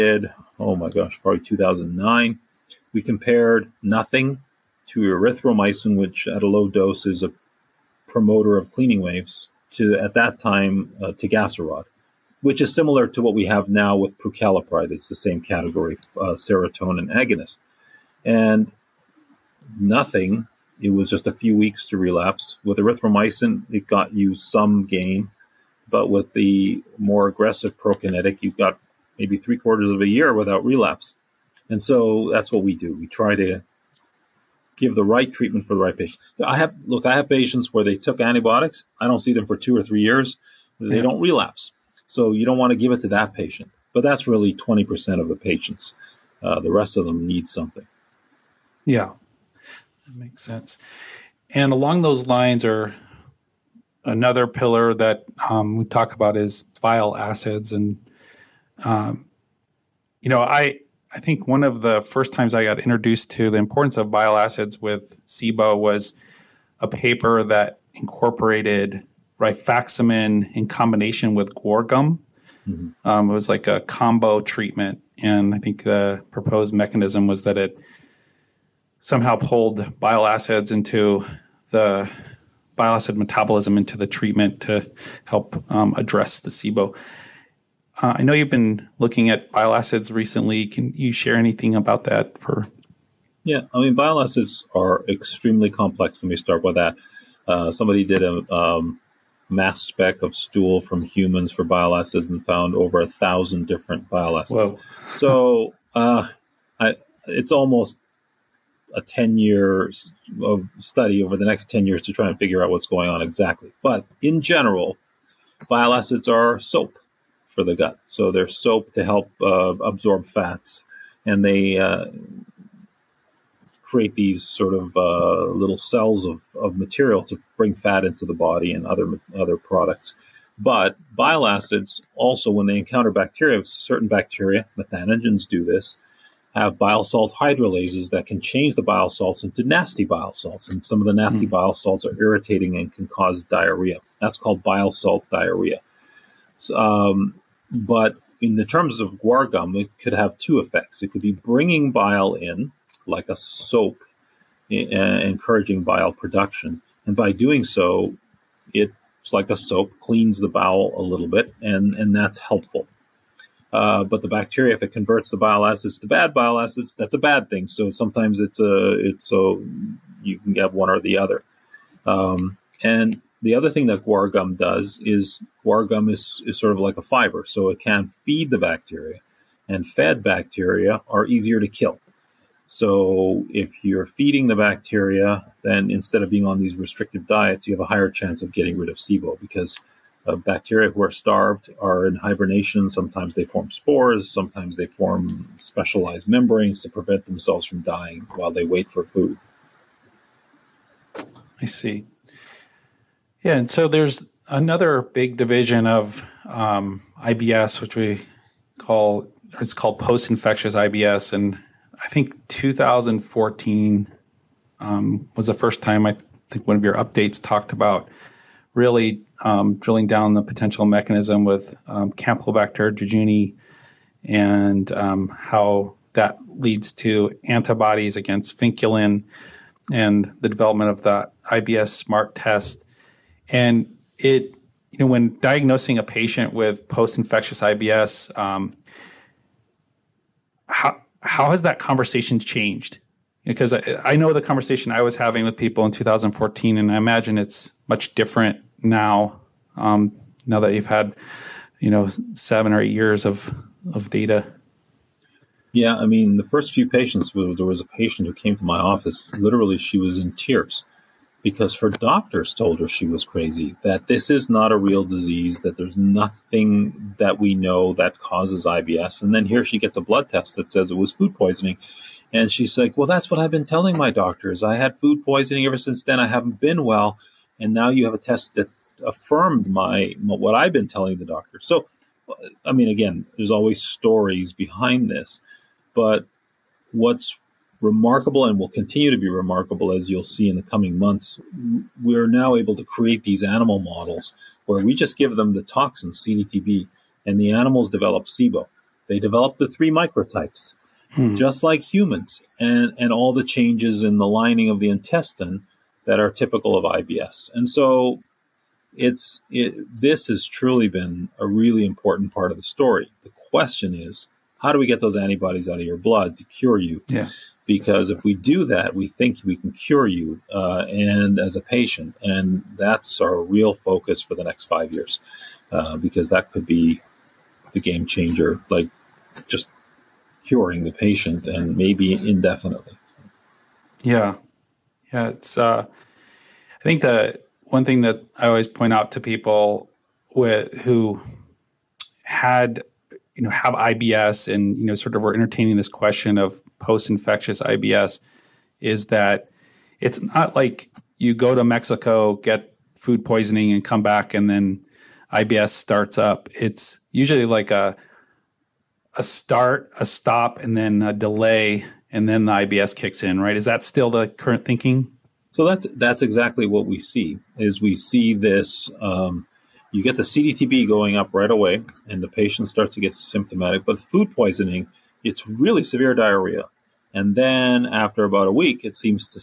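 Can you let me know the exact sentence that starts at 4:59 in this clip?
They develop the three microtypes, hmm.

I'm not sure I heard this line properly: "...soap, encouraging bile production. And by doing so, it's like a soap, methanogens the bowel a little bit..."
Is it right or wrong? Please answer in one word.
wrong.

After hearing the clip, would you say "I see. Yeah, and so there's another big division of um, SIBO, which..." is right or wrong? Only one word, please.
wrong.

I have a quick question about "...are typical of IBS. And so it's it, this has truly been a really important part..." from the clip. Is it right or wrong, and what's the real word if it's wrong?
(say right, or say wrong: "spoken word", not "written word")
right.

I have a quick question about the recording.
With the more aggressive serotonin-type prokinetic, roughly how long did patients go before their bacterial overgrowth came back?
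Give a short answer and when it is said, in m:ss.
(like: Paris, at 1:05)
Three quarters of a year, at 0:29.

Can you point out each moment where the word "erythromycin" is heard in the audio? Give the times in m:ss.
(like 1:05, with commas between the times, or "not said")
0:05, 0:22.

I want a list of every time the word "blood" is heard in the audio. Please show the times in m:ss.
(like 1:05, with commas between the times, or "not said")
4:30, 5:15.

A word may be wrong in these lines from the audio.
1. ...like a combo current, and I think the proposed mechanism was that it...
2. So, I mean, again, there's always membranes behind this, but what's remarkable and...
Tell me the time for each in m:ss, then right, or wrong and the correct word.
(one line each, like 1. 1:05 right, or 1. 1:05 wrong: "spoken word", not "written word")
1. 1:13 wrong: "treatment", not "current"
2. 4:41 wrong: "stories", not "membranes".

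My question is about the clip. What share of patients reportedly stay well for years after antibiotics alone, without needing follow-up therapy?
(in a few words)
20 percent.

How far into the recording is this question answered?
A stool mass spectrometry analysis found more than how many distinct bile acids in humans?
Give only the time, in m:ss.
1:42.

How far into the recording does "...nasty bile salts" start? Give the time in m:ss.
2:19.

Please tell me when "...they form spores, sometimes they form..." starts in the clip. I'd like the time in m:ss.
3:13.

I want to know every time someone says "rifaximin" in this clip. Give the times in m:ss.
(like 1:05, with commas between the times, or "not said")
1:09.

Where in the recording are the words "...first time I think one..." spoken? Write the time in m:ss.
3:35.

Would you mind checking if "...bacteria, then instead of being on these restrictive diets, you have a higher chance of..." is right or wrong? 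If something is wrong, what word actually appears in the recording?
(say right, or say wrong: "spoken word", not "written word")
right.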